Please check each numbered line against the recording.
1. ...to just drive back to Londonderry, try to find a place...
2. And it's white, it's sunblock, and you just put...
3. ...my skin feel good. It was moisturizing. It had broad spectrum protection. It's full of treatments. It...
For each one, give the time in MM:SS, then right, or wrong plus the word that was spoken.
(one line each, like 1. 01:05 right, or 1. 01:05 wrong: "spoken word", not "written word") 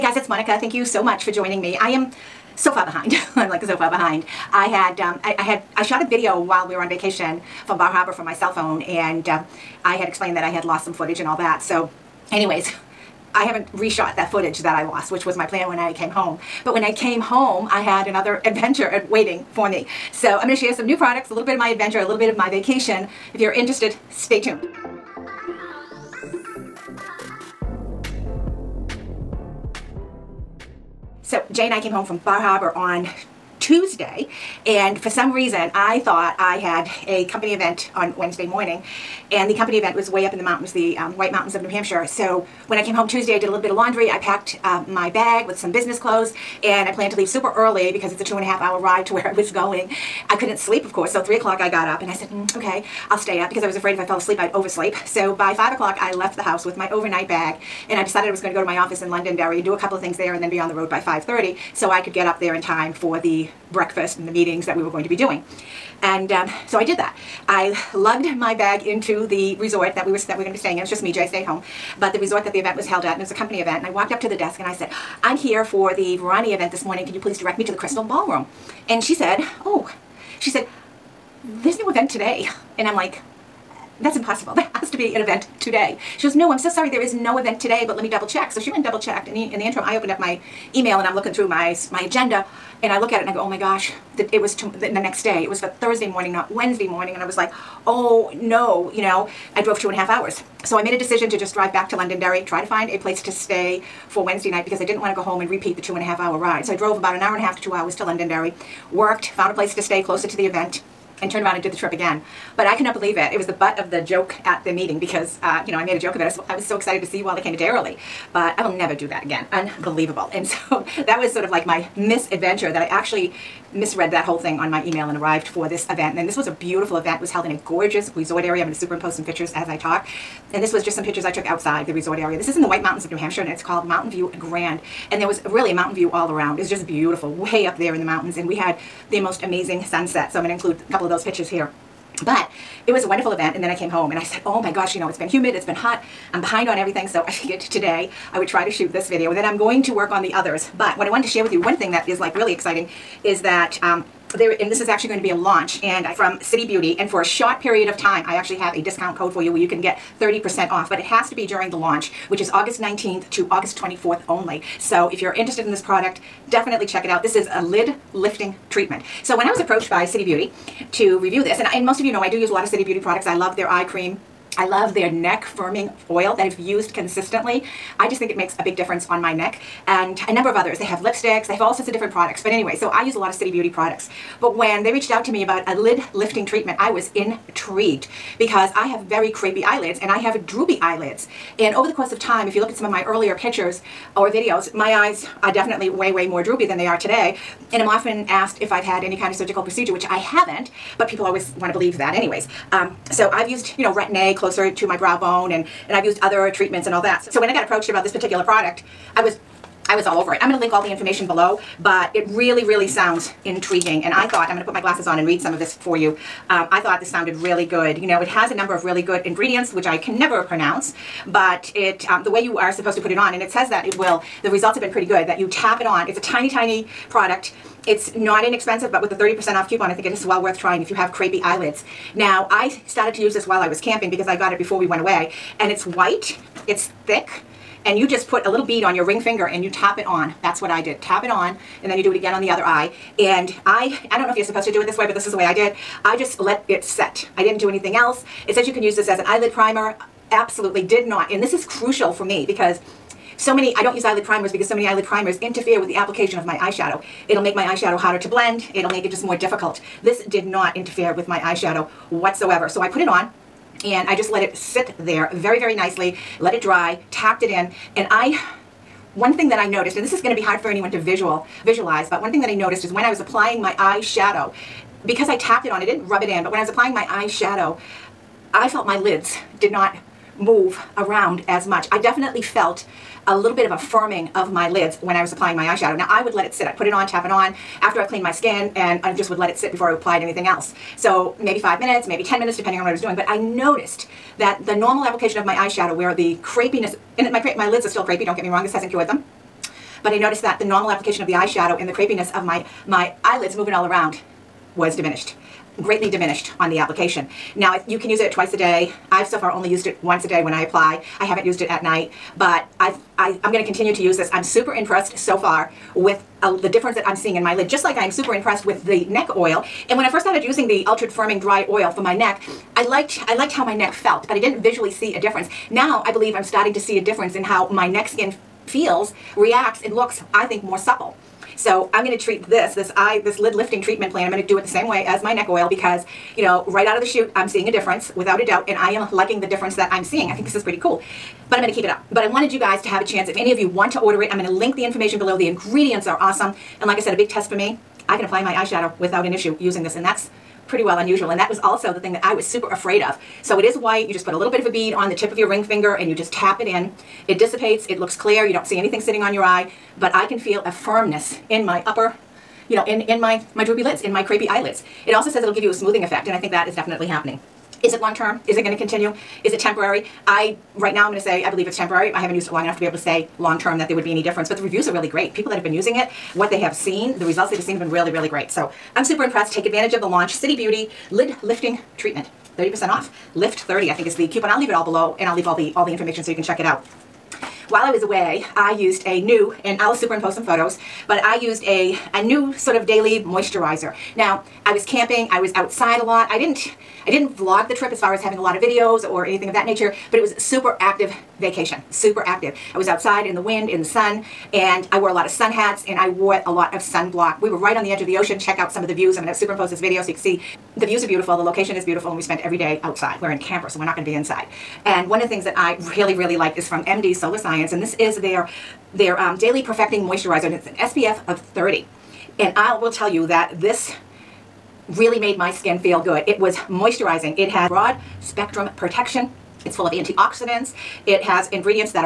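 1. 01:41 right
2. 03:55 wrong: "thick", not "sunblock"
3. 07:05 wrong: "antioxidants", not "treatments".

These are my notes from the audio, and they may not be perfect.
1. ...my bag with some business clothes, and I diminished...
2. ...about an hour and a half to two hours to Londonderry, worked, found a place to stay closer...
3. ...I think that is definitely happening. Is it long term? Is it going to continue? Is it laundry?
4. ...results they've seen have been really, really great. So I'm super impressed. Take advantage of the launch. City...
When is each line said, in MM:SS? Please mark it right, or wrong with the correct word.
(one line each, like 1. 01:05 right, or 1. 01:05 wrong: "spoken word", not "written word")
1. 00:44 wrong: "planned", not "diminished"
2. 01:46 right
3. 06:06 wrong: "temporary", not "laundry"
4. 06:17 right.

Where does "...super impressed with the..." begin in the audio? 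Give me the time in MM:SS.
05:18.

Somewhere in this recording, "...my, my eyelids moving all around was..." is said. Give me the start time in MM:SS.
05:02.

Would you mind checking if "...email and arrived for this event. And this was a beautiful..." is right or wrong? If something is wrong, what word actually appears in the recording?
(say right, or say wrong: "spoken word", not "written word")
right.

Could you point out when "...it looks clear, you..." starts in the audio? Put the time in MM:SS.
05:57.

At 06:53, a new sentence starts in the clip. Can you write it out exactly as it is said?
We're in a camper, so we're not going to be inside.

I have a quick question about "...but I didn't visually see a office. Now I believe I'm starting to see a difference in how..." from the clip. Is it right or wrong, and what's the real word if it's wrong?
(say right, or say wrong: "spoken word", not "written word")
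wrong: "difference", not "office".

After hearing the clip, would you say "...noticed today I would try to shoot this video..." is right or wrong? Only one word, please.
wrong.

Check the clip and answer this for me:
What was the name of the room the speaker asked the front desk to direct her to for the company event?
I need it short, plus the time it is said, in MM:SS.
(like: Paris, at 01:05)
Crystal Ballroom, at 01:17.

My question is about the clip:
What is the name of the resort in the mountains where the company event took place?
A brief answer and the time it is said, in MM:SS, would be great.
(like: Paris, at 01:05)
Mountain View Grand, at 02:13.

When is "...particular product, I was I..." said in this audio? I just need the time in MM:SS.
03:28.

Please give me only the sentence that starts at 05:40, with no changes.
I think this is pretty cool.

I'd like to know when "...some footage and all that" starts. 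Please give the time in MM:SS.
00:10.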